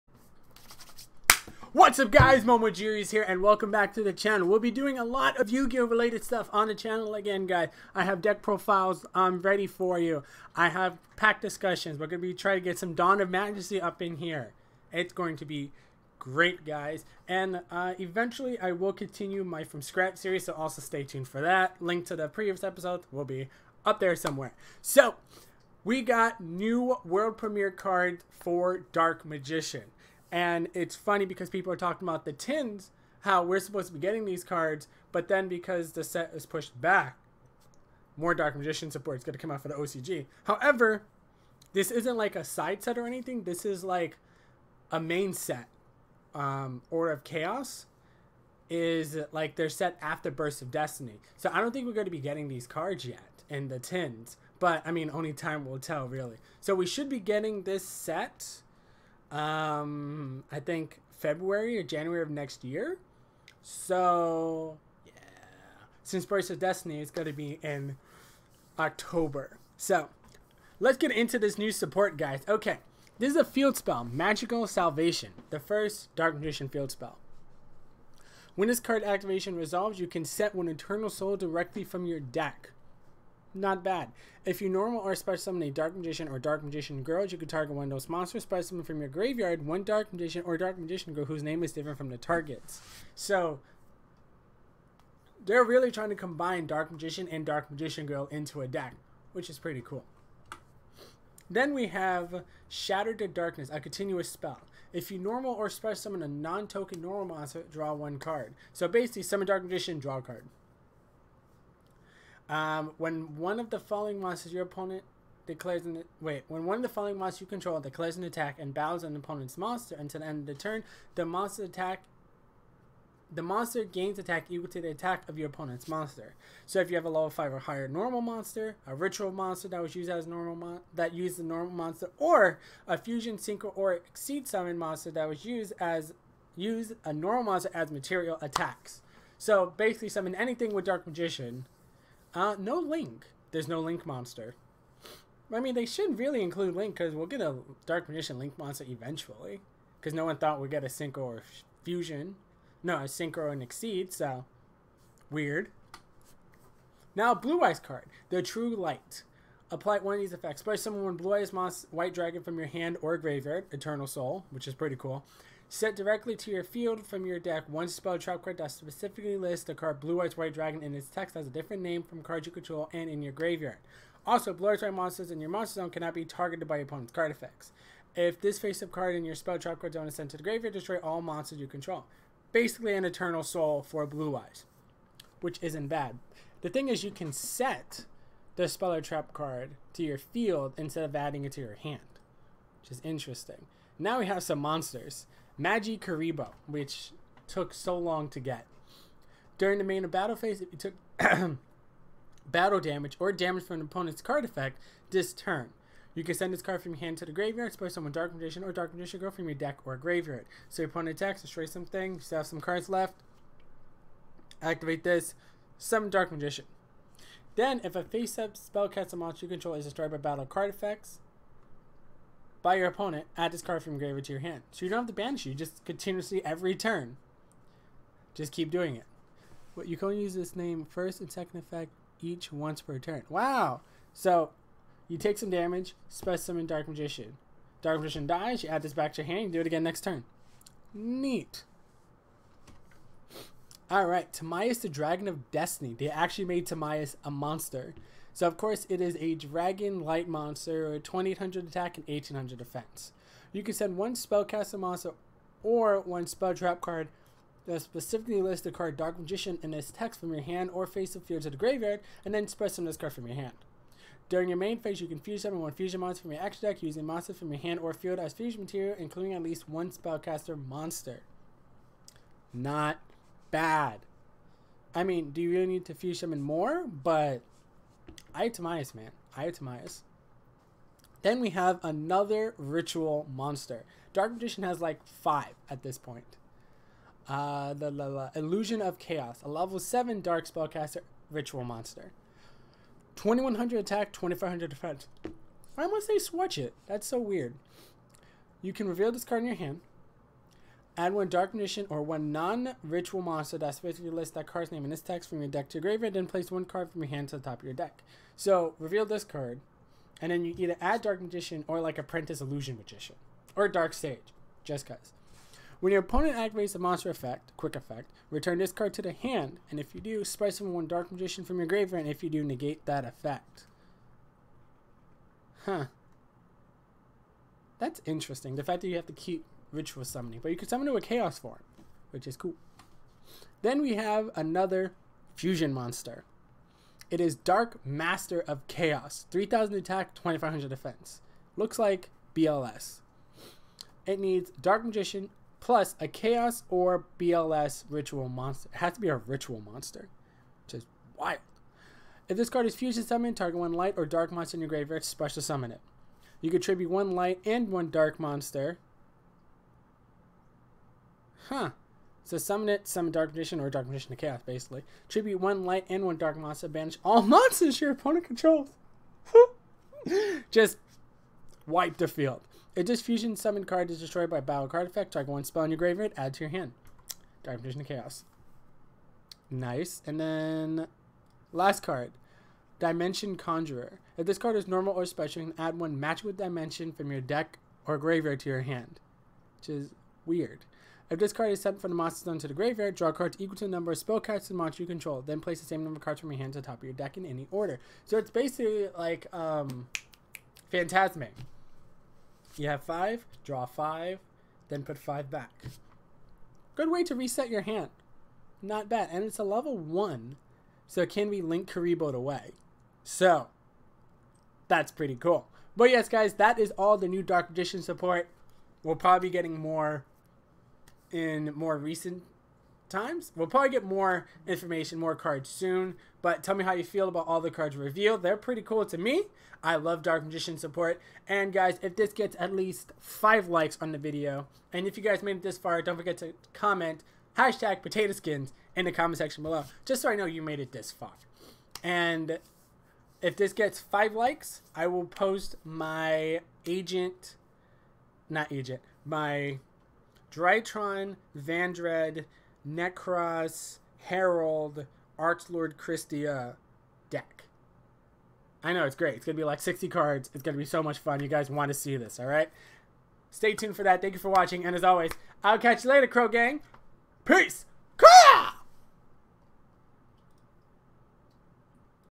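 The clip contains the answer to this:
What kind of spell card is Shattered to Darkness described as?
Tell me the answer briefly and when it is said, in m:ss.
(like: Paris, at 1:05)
continuous spell, at 1:43.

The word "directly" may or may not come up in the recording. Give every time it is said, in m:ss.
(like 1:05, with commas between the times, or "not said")
1:21, 2:45.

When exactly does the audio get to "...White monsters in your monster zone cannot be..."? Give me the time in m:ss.
2:54.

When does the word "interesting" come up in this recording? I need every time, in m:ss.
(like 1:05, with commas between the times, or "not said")
3:13, 5:28.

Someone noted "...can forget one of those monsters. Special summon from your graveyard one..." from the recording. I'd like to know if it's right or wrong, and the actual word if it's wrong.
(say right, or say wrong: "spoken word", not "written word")
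wrong: "target", not "forget".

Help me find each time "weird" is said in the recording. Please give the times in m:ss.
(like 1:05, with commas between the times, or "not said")
2:35, 4:57, 6:30.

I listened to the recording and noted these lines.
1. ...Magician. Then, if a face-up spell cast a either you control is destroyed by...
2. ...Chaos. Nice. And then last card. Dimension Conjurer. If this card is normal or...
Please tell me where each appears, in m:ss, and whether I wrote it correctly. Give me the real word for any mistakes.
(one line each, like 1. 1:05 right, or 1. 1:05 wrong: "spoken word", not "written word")
1. 3:36 wrong: "monster", not "either"
2. 6:17 right.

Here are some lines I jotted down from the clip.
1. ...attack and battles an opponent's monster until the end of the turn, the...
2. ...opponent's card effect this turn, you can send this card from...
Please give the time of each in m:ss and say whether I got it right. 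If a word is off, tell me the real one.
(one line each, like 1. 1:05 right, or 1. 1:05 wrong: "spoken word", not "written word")
1. 1:58 right
2. 3:23 right.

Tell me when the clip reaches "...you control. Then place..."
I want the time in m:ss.
6:34.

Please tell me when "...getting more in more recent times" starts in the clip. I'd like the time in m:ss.
6:59.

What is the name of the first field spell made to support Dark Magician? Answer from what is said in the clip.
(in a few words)
Magician's Salvation.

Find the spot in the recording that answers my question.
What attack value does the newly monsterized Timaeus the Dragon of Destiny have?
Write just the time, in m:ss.
4:10.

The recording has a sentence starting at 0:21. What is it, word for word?
Link to the previous episode will be up there somewhere.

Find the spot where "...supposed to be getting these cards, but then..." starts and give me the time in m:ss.
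0:33.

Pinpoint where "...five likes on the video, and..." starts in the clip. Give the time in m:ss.
7:12.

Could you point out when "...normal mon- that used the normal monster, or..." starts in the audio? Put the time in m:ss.
2:10.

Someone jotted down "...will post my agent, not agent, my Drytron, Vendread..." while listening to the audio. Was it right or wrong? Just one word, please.
right.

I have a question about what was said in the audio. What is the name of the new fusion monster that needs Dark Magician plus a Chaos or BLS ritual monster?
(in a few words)
Dark Master of Chaos.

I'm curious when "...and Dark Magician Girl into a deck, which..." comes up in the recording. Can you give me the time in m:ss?
1:37.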